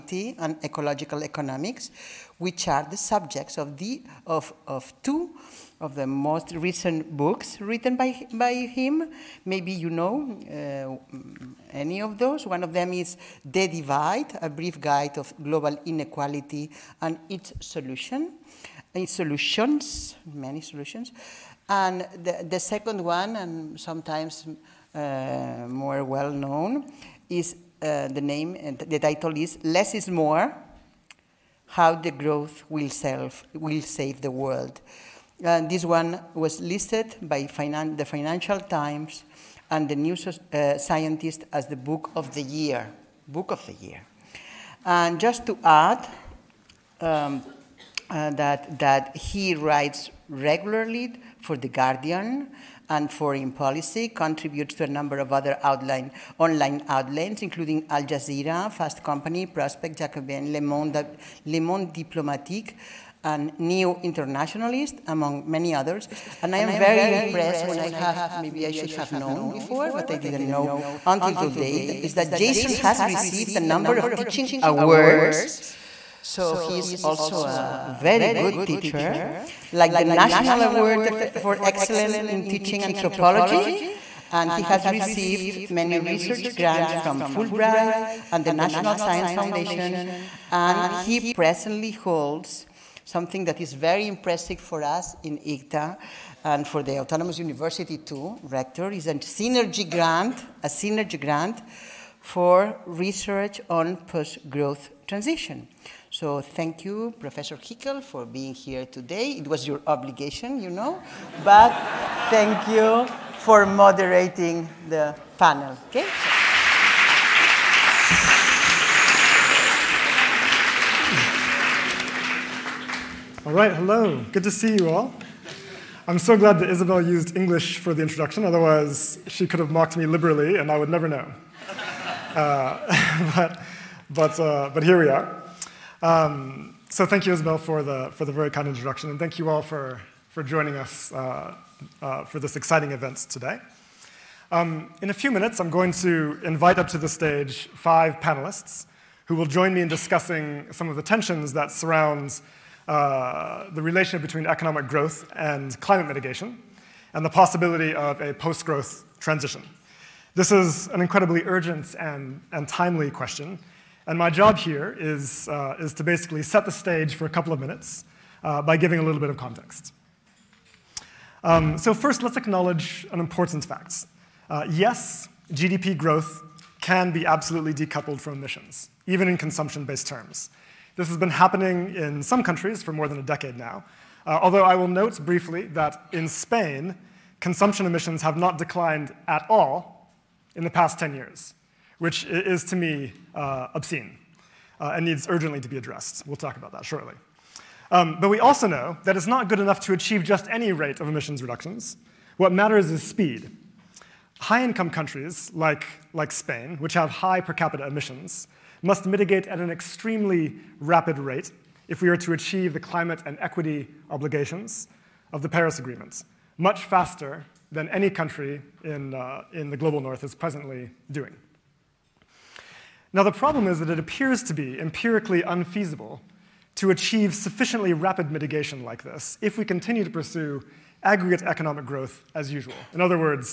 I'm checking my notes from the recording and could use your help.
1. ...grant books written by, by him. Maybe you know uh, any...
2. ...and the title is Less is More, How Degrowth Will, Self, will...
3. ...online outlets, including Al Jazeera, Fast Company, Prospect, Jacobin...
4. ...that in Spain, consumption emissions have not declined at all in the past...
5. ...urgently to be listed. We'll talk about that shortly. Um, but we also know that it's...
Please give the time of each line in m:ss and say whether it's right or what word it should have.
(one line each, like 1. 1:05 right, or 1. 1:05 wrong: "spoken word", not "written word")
1. 0:06 wrong: "recent", not "grant"
2. 0:28 right
3. 0:56 right
4. 3:05 right
5. 3:15 wrong: "addressed", not "listed".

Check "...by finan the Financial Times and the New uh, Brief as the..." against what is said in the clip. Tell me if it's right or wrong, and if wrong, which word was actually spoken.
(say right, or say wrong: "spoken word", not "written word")
wrong: "Scientist", not "Brief".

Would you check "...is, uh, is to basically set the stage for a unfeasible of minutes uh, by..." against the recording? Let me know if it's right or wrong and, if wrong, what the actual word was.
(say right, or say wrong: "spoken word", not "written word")
wrong: "couple", not "unfeasible".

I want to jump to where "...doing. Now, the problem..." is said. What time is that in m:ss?
3:41.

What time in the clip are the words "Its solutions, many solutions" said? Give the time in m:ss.
0:18.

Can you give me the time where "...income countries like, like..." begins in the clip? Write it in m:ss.
3:24.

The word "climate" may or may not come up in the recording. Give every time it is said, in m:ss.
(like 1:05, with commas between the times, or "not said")
2:35, 3:32.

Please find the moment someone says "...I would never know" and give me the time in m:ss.
2:10.